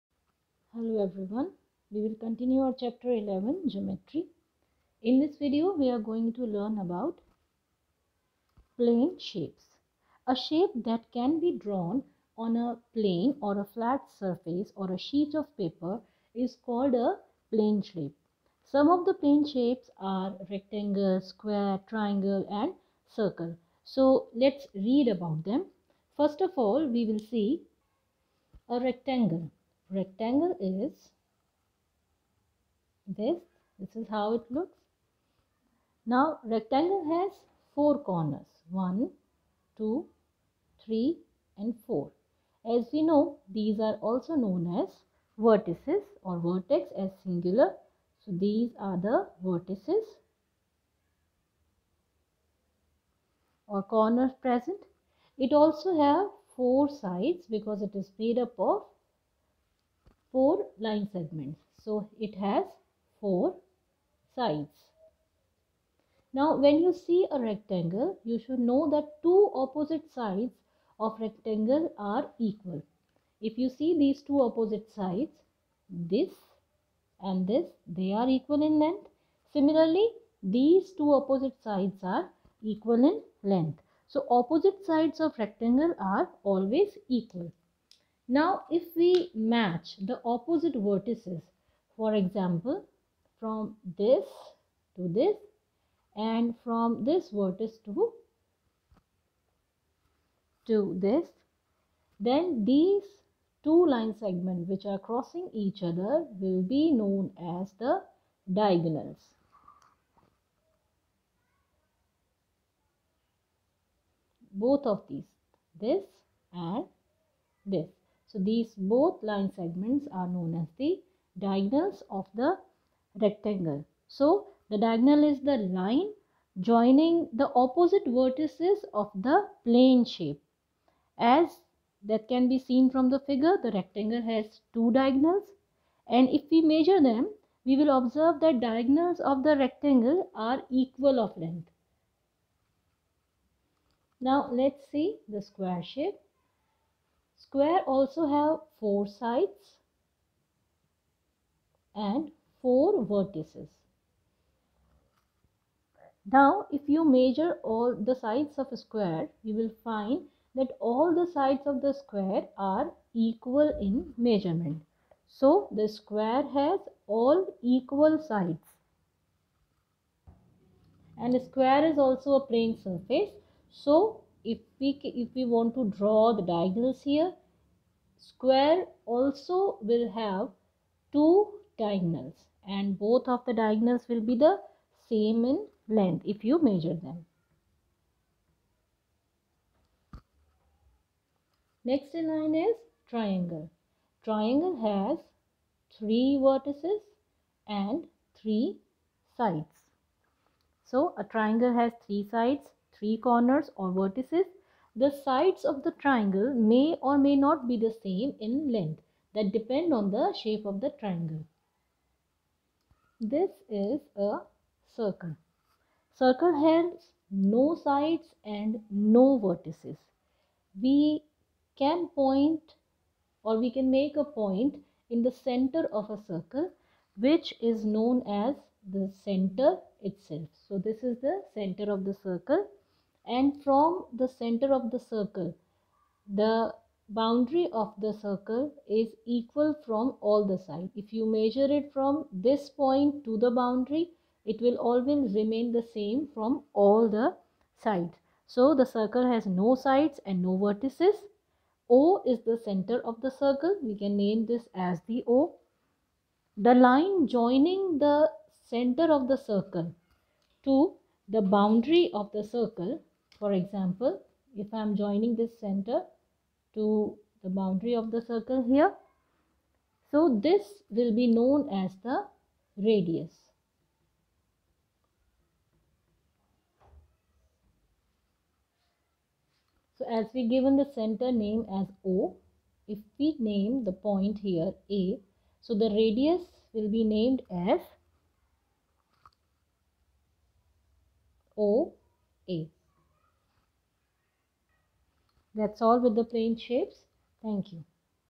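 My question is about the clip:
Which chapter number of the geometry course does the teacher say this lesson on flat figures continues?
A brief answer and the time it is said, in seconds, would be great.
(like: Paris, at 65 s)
11, at 2 s.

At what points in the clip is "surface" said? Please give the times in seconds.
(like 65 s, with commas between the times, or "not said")
14 s, 172 s.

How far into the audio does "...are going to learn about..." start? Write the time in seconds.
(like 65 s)
5 s.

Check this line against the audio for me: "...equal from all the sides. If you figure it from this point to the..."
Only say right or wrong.
wrong.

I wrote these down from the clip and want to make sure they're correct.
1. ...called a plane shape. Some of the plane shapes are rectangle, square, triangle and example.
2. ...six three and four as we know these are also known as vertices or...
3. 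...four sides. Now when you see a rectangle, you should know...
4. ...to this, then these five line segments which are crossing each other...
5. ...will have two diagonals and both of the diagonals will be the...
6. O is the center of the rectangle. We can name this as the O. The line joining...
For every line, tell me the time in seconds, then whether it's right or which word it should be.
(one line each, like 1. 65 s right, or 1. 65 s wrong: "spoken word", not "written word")
1. 16 s wrong: "circle", not "example"
2. 39 s wrong: "two", not "six"
3. 63 s right
4. 100 s wrong: "two", not "five"
5. 179 s right
6. 251 s wrong: "circle", not "rectangle".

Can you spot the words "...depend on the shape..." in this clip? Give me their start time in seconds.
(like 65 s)
209 s.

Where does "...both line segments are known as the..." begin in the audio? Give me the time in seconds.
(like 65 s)
118 s.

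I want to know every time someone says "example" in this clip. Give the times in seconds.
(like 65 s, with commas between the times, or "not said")
92 s, 263 s.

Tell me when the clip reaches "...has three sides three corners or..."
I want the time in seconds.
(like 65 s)
201 s.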